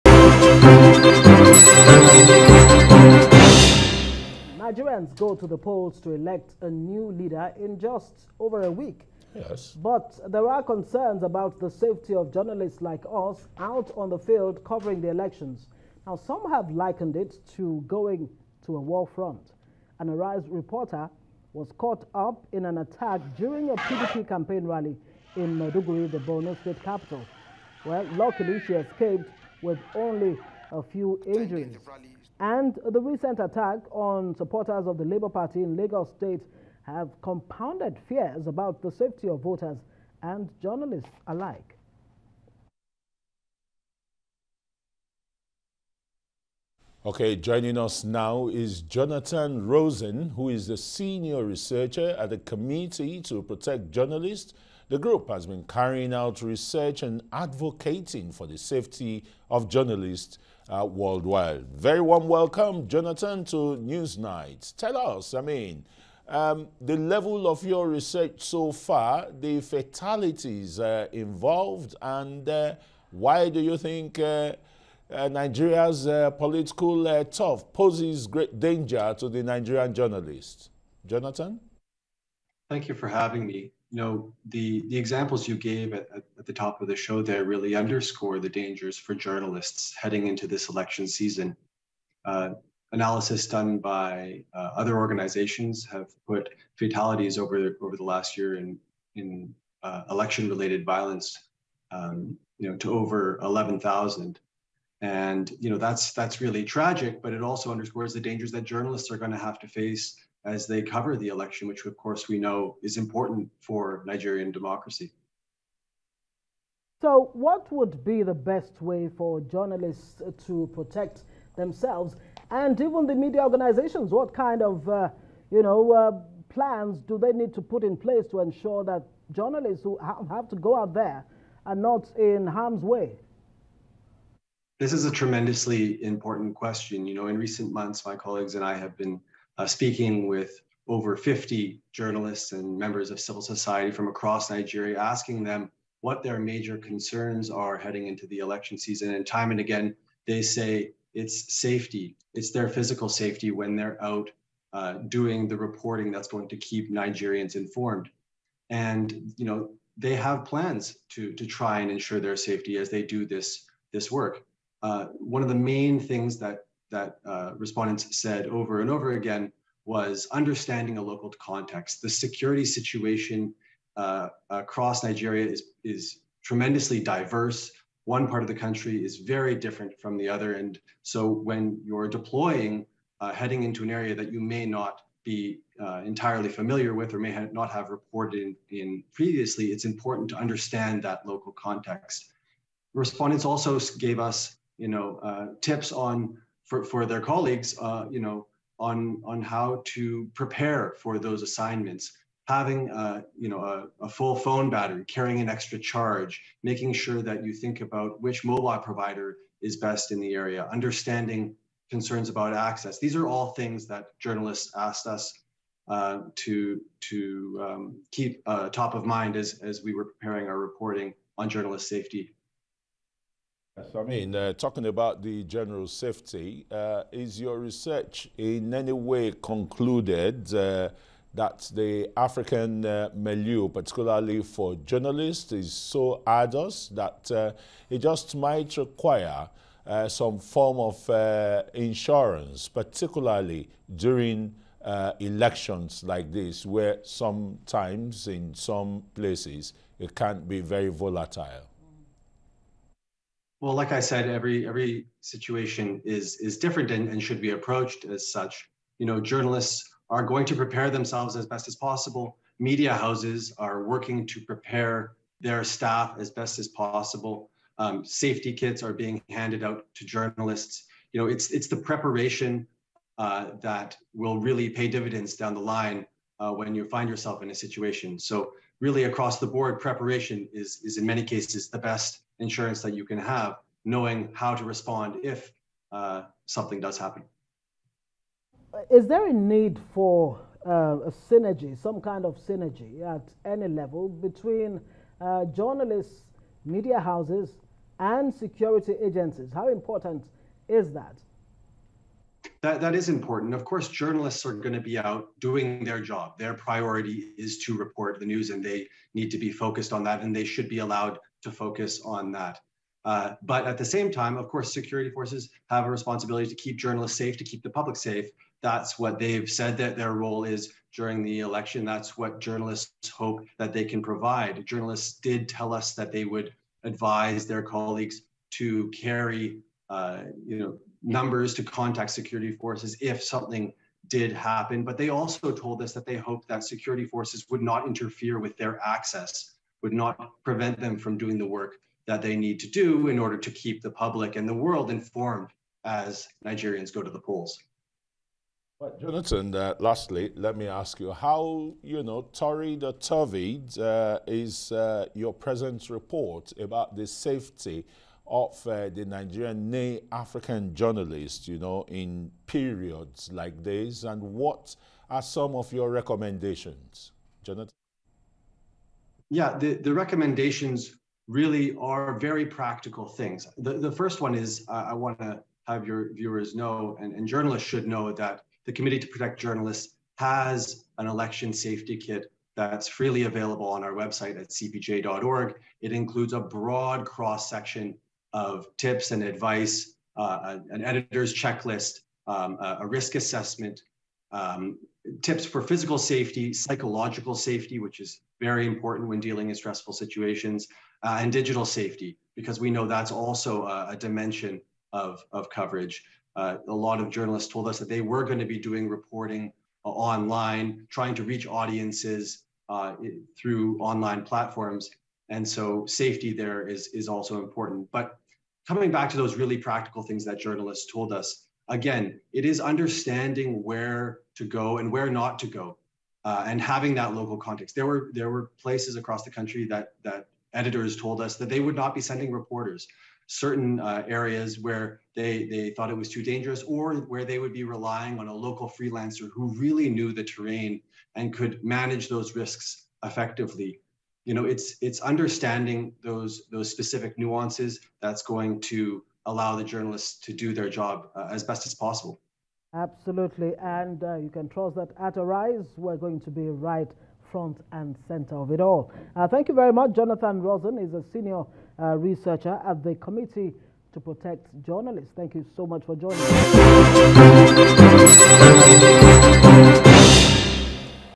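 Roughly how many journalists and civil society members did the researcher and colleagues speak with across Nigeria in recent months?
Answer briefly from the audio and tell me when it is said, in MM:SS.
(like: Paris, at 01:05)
over 50, at 02:20.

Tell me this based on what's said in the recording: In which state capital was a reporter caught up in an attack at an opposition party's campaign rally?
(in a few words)
Maiduguri.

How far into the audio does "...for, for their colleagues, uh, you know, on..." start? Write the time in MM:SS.
03:16.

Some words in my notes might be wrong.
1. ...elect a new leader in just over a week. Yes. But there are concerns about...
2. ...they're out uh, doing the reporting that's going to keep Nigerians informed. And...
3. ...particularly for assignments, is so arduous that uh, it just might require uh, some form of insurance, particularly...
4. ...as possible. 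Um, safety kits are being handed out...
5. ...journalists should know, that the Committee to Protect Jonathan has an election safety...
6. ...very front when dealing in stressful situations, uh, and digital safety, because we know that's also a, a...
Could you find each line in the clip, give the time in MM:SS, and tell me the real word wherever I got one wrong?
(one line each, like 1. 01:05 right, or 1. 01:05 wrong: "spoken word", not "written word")
1. 00:06 right
2. 02:33 right
3. 03:53 wrong: "journalists", not "assignments"
4. 04:26 right
5. 06:17 wrong: "Journalists", not "Jonathan"
6. 06:38 wrong: "important", not "front".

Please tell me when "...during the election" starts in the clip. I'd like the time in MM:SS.
05:20.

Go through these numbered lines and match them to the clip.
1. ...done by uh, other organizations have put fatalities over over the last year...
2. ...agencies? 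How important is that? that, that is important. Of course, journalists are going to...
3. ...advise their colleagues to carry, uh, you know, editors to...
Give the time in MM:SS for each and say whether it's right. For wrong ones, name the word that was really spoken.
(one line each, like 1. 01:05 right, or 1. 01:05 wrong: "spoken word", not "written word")
1. 01:33 right
2. 04:59 right
3. 05:26 wrong: "numbers", not "editors".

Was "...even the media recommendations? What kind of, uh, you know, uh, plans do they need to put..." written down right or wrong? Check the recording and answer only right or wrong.
wrong.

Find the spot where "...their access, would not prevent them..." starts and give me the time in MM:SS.
05:38.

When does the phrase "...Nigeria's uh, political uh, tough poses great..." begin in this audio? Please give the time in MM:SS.
01:15.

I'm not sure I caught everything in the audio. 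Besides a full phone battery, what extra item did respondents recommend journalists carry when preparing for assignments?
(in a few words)
an extra charge.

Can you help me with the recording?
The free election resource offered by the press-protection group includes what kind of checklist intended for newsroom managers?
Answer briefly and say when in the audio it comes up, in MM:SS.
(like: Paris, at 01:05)
editor's checklist, at 06:30.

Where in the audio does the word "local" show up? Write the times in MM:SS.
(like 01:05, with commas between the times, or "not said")
02:51, 03:11, 07:07, 07:18.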